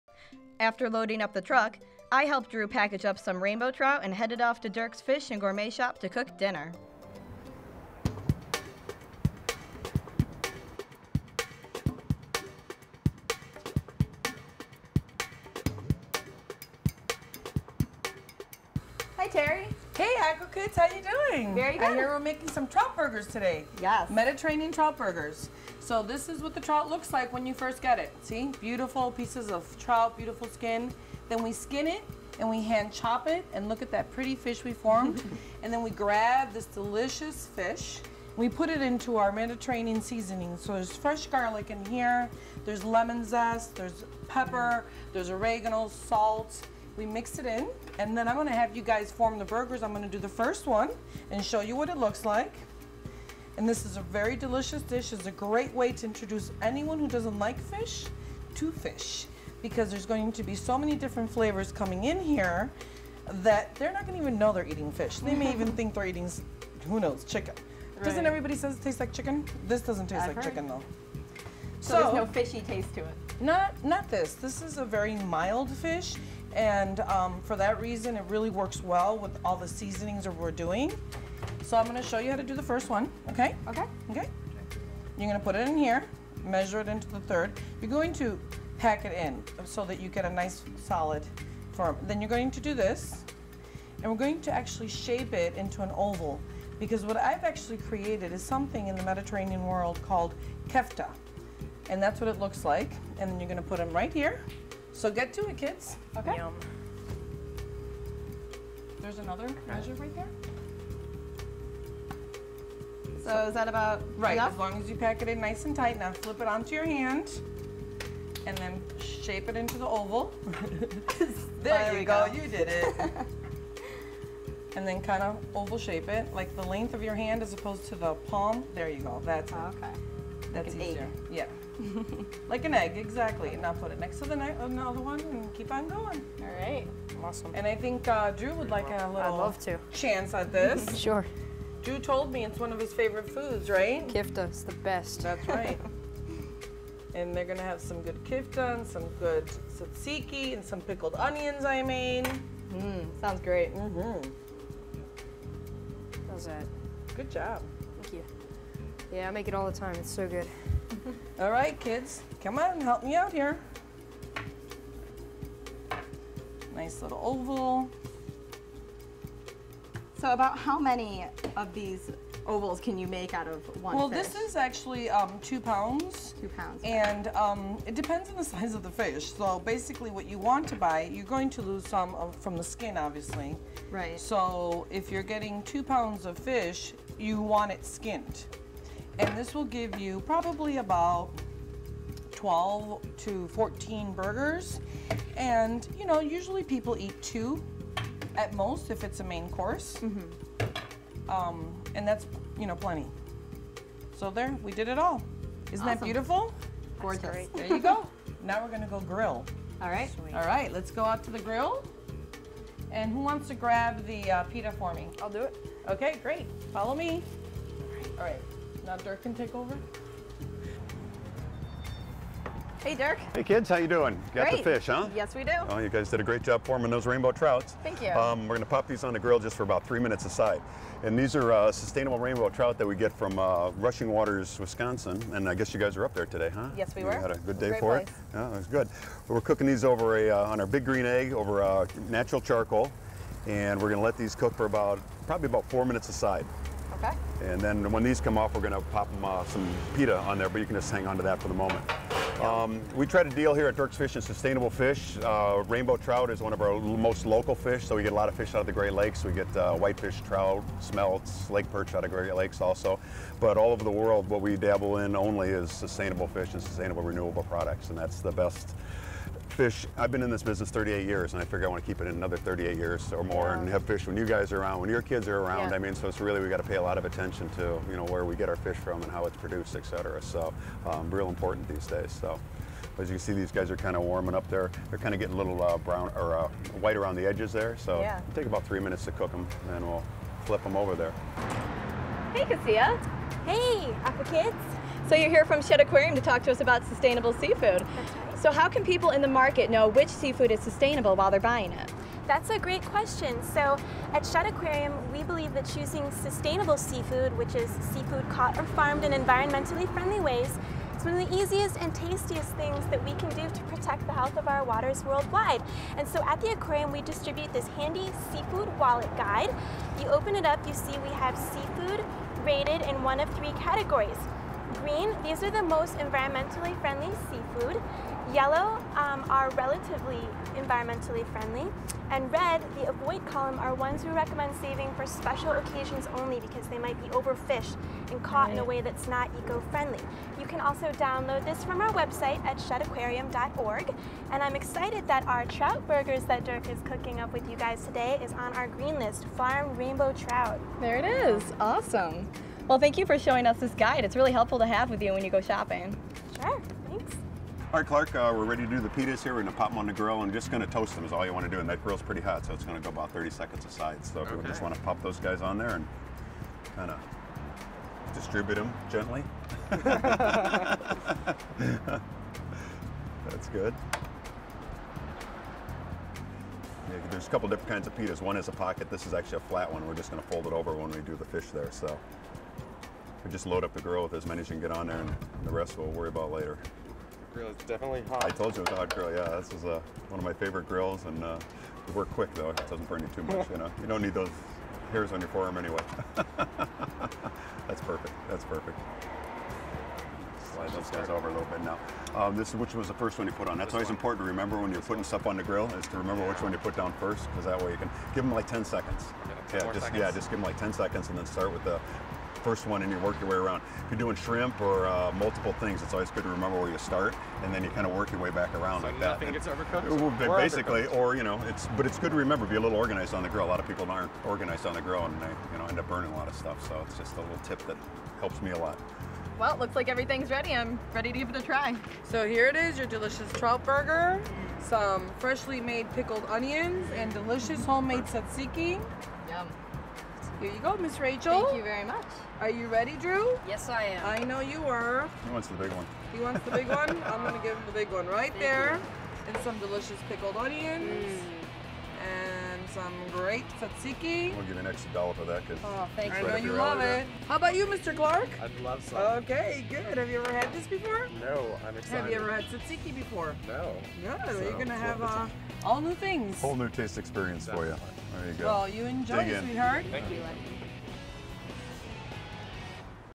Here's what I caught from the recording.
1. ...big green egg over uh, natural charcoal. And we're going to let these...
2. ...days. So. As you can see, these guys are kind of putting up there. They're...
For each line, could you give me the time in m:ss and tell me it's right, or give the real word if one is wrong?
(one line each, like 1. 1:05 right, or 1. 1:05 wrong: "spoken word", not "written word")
1. 4:00 right
2. 4:41 wrong: "warming", not "putting".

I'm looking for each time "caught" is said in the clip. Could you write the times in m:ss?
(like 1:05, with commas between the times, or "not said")
5:08, 5:38.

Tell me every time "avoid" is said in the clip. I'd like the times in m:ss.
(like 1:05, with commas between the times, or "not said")
5:32.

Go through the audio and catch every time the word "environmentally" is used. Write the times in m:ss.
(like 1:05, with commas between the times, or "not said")
5:09, 5:25, 5:30.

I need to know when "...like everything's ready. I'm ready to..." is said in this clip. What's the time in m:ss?
7:09.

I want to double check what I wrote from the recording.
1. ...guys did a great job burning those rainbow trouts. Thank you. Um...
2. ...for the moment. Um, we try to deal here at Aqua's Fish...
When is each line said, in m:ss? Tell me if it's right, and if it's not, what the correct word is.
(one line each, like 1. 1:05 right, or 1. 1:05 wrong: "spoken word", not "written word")
1. 3:45 wrong: "forming", not "burning"
2. 4:11 wrong: "Dirk", not "Aqua".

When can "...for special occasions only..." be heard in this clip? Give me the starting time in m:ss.
5:34.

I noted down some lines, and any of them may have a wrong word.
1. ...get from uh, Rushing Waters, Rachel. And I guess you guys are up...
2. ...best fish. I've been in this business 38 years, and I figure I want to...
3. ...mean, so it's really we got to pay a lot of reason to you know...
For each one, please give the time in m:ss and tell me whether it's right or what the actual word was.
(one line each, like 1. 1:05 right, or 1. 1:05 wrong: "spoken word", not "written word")
1. 3:52 wrong: "Wisconsin", not "Rachel"
2. 4:28 right
3. 4:35 wrong: "attention", not "reason".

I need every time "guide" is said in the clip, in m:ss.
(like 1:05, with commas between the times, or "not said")
5:19, 5:53.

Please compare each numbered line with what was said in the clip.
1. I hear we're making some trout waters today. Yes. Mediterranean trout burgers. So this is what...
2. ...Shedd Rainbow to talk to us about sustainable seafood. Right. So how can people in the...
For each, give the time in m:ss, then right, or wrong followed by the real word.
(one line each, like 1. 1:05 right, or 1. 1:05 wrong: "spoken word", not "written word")
1. 0:21 wrong: "burgers", not "waters"
2. 4:55 wrong: "Aquarium", not "Rainbow".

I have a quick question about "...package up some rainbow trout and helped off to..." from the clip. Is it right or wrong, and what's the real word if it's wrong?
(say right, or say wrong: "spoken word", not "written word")
wrong: "headed", not "helped".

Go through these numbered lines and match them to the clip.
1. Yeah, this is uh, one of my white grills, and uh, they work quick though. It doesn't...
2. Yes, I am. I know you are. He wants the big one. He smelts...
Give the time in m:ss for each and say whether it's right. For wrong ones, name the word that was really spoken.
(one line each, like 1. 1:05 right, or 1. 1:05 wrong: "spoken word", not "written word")
1. 6:29 wrong: "favorite", not "white"
2. 7:23 wrong: "wants", not "smelts".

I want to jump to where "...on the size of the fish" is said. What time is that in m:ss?
2:58.